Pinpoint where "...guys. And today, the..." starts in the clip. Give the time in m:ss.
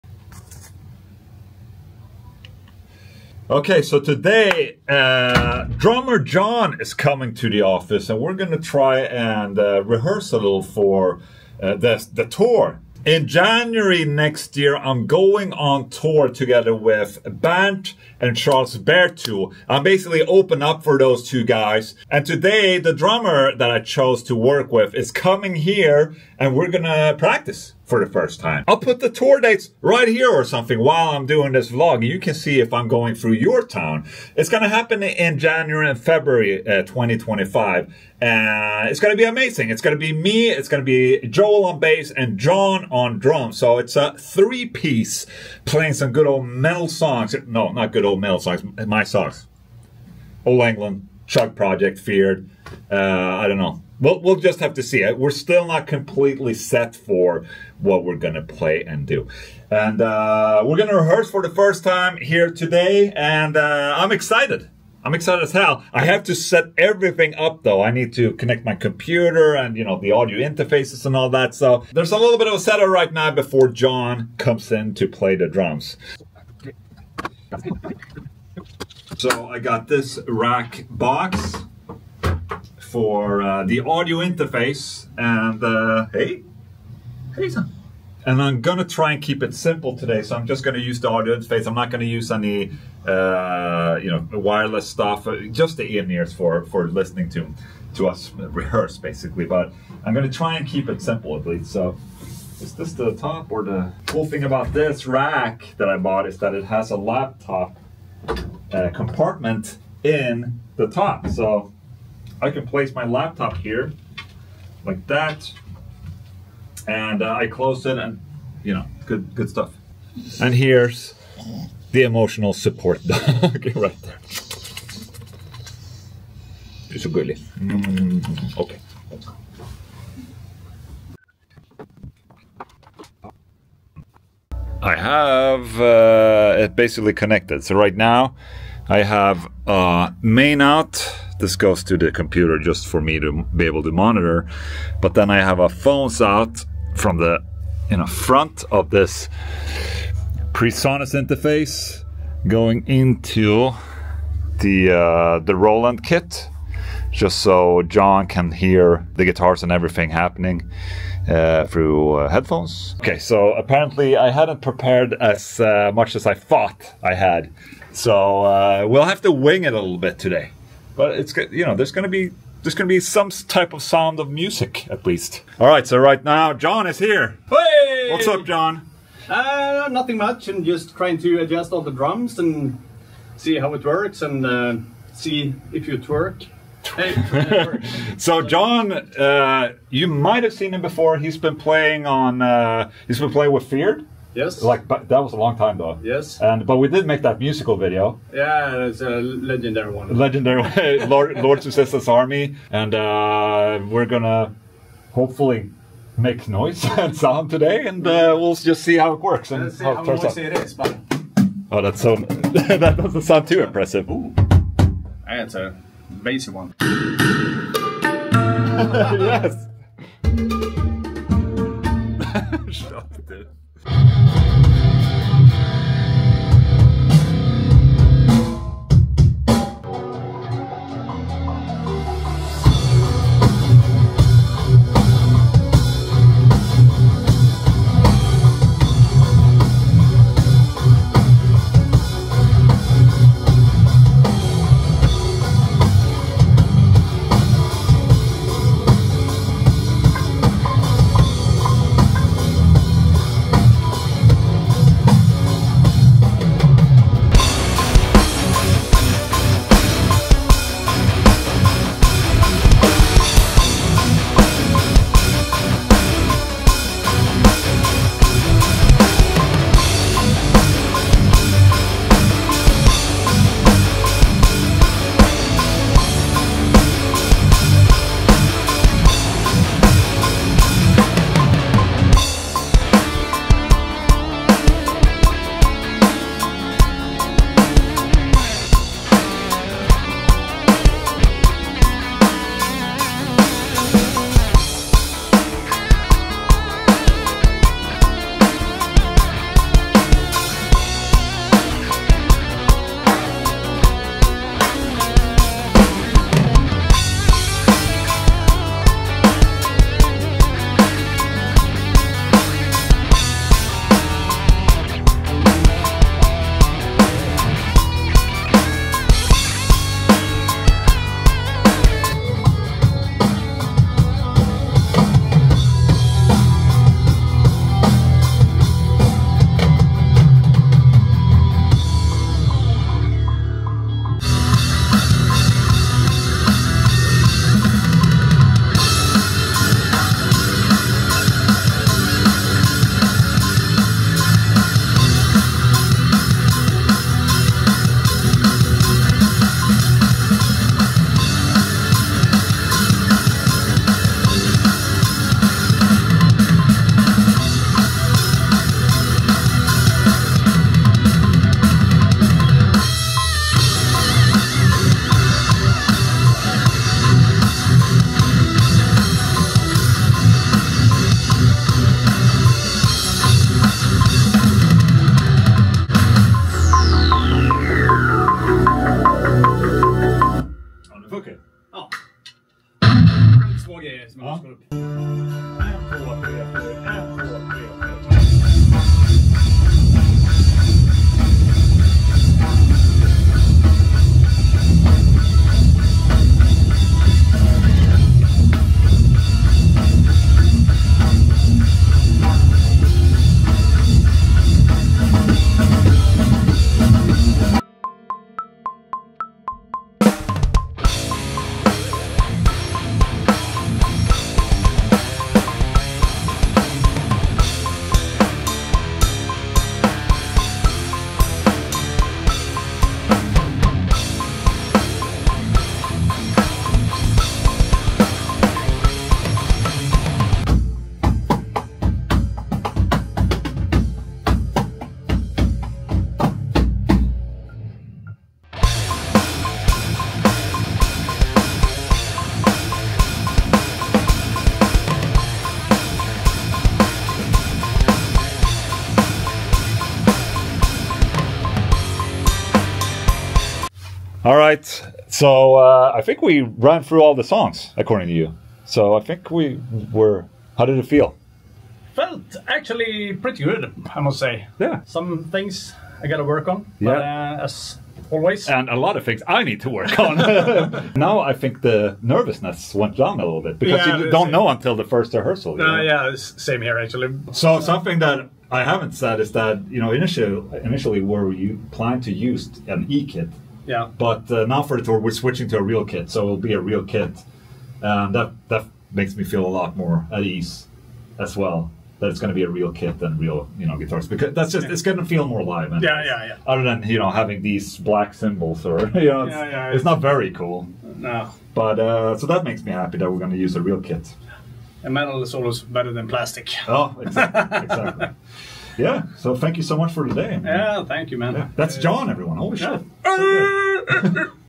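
0:21.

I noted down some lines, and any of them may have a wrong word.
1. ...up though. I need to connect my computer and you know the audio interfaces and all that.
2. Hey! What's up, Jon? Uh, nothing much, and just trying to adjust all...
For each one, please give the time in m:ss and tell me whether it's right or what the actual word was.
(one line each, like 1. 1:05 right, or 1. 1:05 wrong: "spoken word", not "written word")
1. 1:07 right
2. 2:57 right.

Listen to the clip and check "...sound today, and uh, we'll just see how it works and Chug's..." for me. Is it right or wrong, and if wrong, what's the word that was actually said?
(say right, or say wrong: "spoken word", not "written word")
wrong: "Let", not "Chug".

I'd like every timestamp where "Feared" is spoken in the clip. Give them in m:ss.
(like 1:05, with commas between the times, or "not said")
0:51, 3:13.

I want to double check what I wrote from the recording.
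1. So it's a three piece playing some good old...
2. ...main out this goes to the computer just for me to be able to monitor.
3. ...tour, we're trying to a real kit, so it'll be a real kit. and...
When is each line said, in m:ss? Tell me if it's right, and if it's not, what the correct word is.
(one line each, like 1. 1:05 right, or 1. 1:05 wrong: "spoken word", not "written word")
1. 0:43 right
2. 2:20 right
3. 8:04 wrong: "switching", not "trying".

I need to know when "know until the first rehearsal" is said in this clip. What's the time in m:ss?
7:54.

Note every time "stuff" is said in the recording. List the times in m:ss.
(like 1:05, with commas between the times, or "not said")
1:34, 1:59.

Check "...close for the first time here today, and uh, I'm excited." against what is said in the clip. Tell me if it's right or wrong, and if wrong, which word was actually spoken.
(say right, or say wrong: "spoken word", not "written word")
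wrong: "rehearse", not "close".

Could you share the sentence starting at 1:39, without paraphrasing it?
But I'm gonna try and keep it simple at least.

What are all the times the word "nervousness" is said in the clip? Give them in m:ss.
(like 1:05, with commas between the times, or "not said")
7:52.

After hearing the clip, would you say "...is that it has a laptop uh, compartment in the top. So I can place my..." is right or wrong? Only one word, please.
right.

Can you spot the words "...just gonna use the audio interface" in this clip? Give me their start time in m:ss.
1:30.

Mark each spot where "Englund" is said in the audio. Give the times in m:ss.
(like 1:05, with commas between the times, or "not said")
0:50.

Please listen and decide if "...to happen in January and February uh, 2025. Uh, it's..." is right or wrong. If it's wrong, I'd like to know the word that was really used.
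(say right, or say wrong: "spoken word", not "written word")
right.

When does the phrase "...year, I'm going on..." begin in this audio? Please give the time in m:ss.
0:14.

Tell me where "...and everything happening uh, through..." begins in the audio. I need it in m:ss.
2:39.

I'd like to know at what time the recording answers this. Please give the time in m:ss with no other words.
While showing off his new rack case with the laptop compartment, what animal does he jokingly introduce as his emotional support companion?
2:03.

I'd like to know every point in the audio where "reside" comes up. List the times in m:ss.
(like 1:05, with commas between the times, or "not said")
not said.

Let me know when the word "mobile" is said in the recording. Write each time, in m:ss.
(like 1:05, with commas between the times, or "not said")
not said.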